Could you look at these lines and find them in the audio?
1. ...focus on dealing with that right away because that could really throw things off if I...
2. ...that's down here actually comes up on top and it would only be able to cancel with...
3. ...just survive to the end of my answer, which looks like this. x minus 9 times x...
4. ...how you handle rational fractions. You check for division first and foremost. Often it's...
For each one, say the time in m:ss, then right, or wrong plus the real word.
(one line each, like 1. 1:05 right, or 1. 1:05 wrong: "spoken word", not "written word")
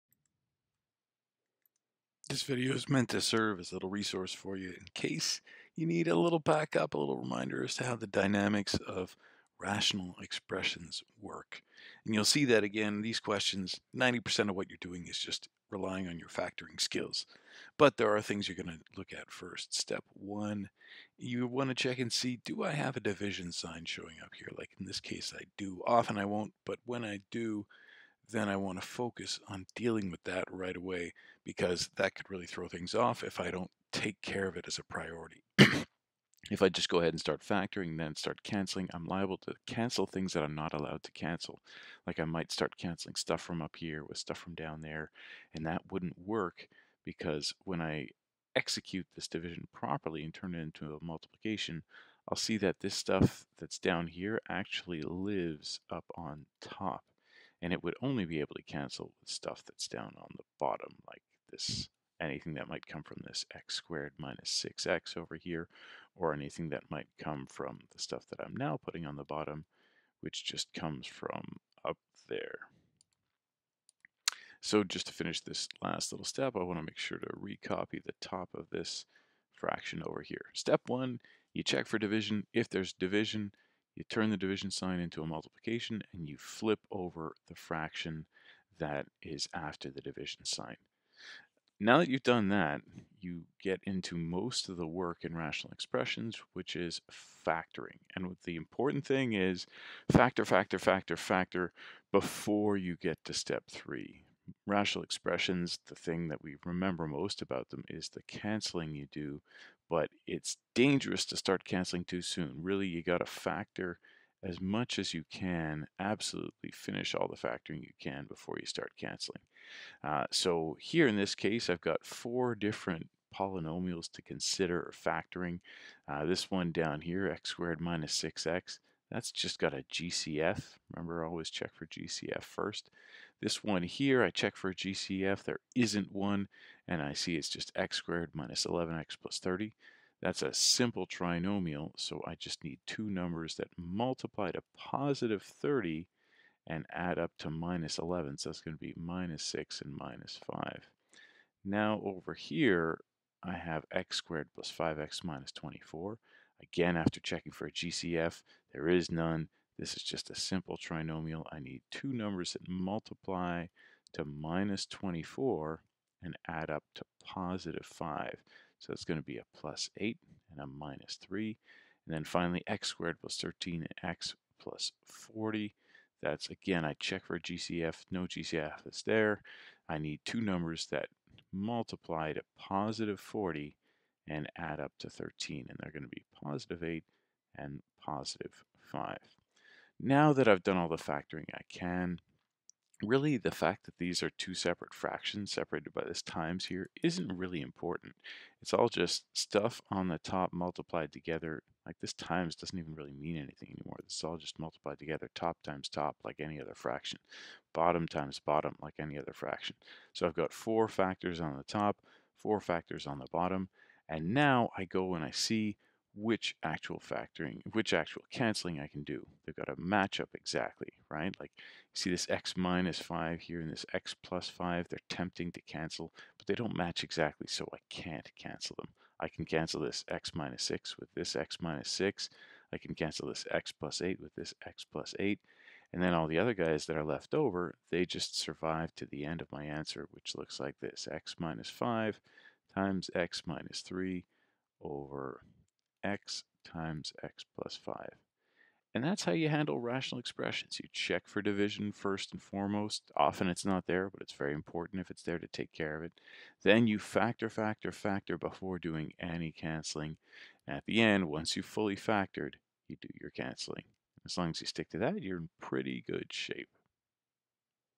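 1. 0:28 right
2. 0:53 wrong: "lives", not "comes"
3. 3:58 wrong: "5", not "9"
4. 4:09 wrong: "expressions", not "fractions".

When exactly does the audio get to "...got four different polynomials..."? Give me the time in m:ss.
2:01.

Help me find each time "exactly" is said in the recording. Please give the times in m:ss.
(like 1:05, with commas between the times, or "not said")
3:40, 3:47.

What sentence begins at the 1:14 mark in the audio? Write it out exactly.
So just to finish this last little step, I want to make sure to recopy the top of this fraction over here.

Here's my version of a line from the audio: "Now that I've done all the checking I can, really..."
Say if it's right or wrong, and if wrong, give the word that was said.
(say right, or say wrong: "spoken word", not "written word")
wrong: "factoring", not "checking".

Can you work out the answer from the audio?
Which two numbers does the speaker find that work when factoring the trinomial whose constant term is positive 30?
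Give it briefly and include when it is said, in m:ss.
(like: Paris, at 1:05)
-6 and -5, at 2:28.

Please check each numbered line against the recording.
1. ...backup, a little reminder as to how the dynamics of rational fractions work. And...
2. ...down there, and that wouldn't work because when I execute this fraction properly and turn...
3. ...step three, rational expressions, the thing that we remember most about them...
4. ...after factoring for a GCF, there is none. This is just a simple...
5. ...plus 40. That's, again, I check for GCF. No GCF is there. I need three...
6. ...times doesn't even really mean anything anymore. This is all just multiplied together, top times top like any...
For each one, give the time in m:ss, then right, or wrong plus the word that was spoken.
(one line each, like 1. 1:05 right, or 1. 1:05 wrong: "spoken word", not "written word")
1. 0:06 wrong: "expressions", not "fractions"
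2. 0:44 wrong: "division", not "fraction"
3. 1:43 right
4. 2:36 wrong: "checking", not "factoring"
5. 2:54 wrong: "two", not "three"
6. 3:22 right.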